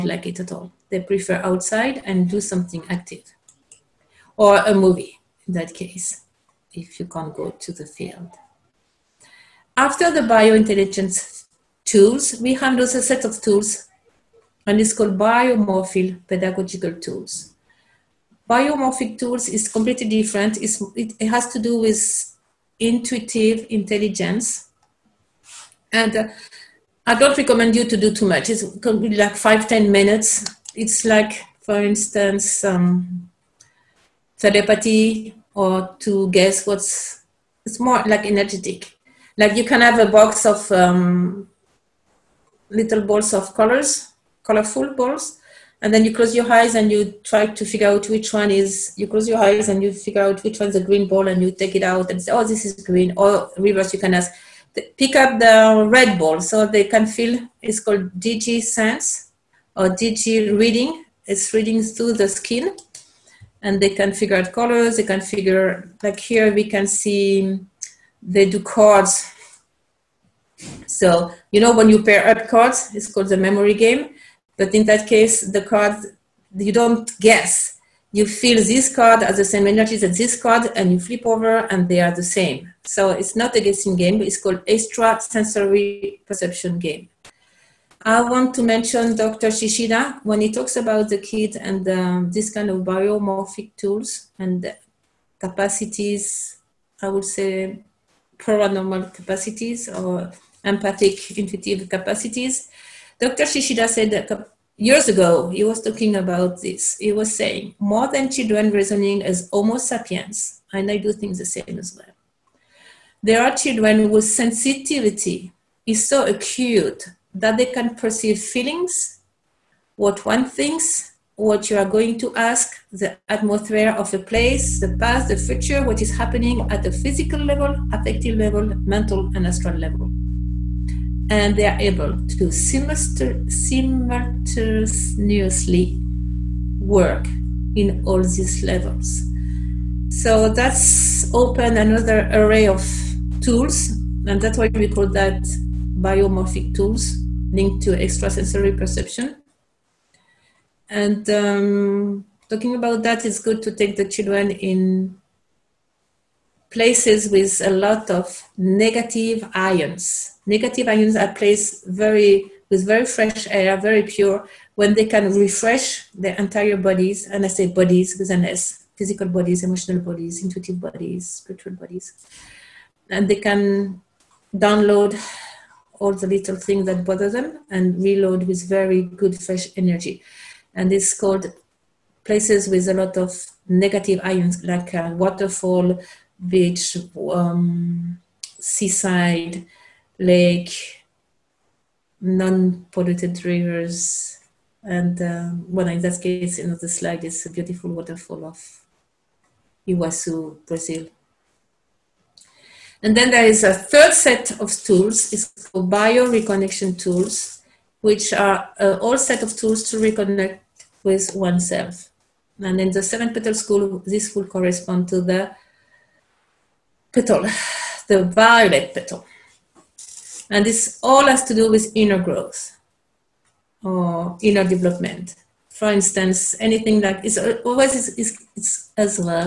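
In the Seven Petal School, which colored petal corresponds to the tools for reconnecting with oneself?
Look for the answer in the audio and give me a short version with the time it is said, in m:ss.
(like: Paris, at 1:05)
Violet, at 3:38.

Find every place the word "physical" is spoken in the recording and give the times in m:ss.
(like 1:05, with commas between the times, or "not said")
2:06, 2:48.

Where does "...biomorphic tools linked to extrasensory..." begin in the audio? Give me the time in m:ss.
2:25.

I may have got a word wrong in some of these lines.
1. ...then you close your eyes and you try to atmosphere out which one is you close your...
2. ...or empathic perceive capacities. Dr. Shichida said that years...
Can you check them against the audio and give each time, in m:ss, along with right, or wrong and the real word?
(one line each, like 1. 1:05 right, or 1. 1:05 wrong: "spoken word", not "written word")
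1. 0:45 wrong: "figure", not "atmosphere"
2. 1:39 wrong: "intuitive", not "perceive".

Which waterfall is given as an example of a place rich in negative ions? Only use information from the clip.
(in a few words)
Iguazu.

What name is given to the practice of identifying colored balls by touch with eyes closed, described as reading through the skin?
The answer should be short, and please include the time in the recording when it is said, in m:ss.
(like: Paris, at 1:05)
DG sense, at 0:58.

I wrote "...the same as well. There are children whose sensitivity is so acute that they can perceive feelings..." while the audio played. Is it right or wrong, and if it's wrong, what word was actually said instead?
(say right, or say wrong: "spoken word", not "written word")
right.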